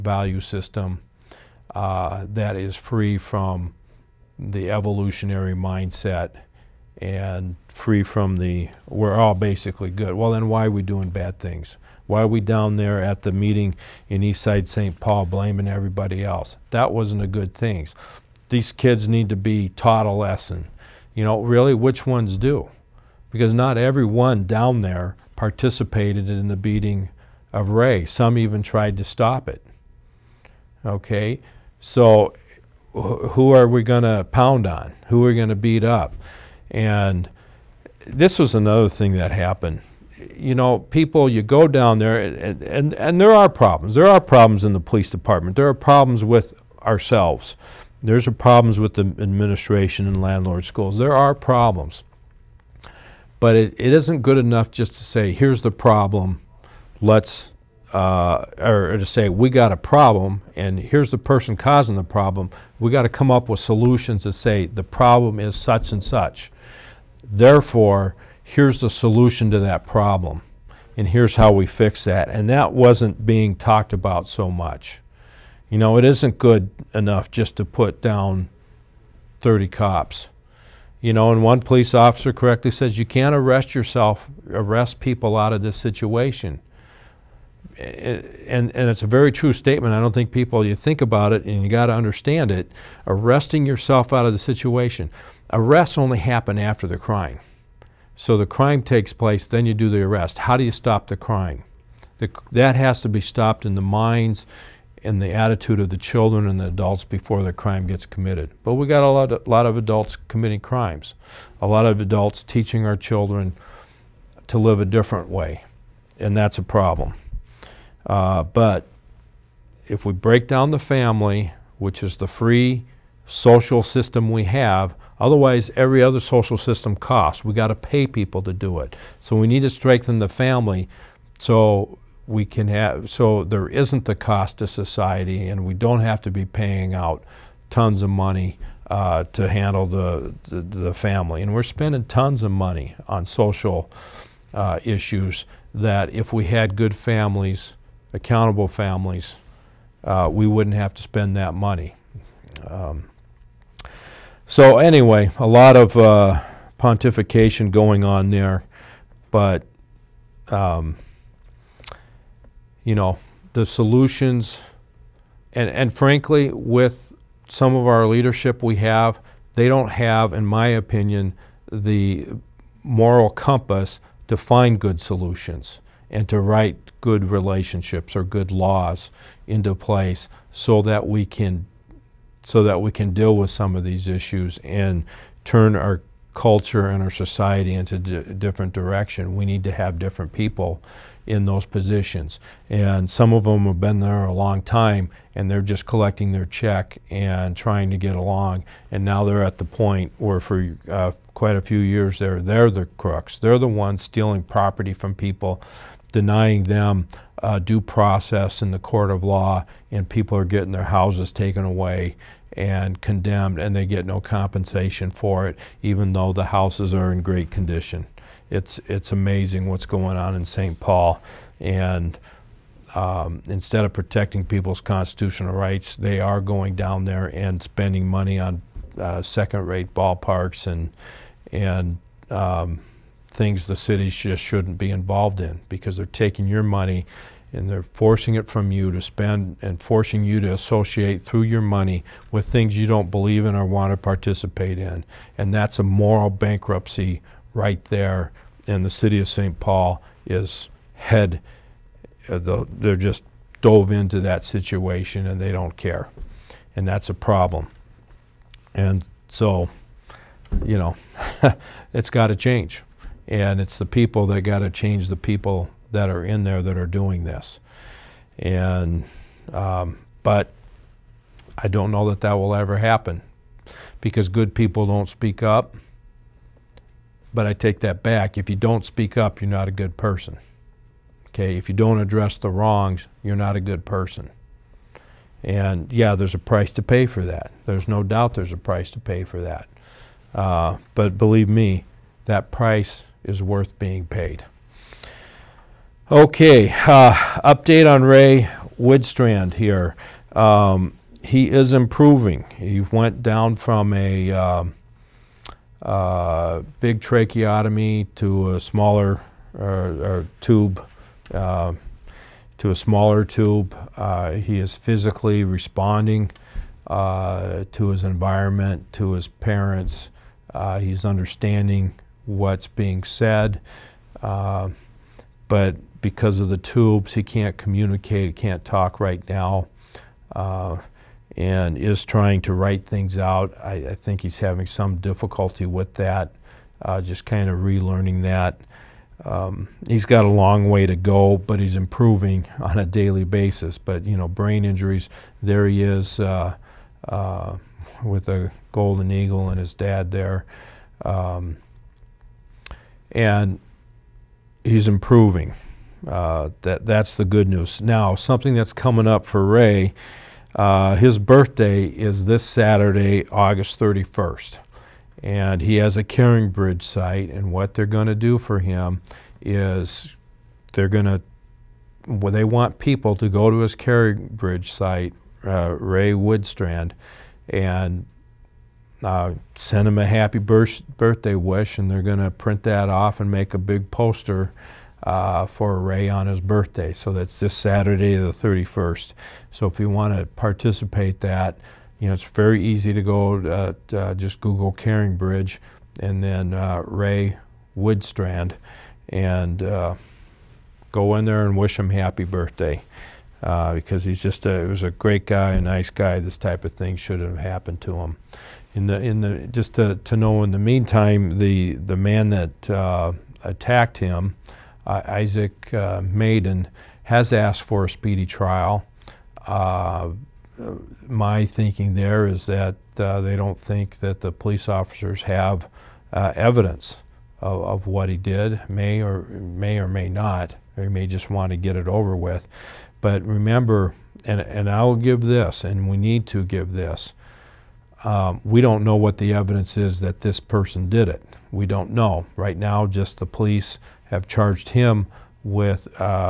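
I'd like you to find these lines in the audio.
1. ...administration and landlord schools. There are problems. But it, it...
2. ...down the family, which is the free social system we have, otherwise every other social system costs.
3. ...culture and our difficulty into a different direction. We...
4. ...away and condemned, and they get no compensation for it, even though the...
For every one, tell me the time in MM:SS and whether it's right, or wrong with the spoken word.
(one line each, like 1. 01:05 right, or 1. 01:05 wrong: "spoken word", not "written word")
1. 00:49 right
2. 02:00 right
3. 03:06 wrong: "society", not "difficulty"
4. 03:31 right.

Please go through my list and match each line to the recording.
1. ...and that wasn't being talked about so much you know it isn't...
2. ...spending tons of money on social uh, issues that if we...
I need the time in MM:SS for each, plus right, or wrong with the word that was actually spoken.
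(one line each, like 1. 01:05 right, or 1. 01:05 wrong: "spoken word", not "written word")
1. 01:12 right
2. 02:21 right.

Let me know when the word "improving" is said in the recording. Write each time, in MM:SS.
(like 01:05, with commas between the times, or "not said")
05:01, 05:41, 05:54.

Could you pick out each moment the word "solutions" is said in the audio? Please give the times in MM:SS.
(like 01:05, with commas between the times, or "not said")
01:03, 01:08, 02:43, 02:55.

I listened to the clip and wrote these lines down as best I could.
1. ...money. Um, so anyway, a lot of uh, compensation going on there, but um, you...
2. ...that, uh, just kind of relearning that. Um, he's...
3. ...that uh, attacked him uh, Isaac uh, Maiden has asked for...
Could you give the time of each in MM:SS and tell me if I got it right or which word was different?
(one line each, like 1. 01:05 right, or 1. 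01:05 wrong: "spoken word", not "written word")
1. 02:31 wrong: "pontification", not "compensation"
2. 05:35 right
3. 06:52 right.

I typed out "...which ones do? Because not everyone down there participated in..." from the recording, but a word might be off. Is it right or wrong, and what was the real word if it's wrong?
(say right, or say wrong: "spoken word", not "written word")
right.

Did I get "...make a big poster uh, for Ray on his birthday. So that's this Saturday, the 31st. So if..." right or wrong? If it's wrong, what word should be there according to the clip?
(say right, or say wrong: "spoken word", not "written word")
right.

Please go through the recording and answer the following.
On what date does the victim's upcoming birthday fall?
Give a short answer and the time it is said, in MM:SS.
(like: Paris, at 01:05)
August 31, at 06:03.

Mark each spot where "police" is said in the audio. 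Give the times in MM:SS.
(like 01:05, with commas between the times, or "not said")
00:44, 01:21, 07:04, 07:23.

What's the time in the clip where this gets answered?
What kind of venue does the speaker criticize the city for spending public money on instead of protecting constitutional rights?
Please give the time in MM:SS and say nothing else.
03:49.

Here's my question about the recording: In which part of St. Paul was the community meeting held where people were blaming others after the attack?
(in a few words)
Eastside St. Paul.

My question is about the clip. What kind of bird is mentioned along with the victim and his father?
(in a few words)
Golden eagle.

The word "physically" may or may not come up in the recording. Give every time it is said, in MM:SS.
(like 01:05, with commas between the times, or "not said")
05:14.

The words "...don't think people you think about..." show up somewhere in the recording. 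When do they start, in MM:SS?
01:30.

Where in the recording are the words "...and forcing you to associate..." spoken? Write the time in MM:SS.
03:59.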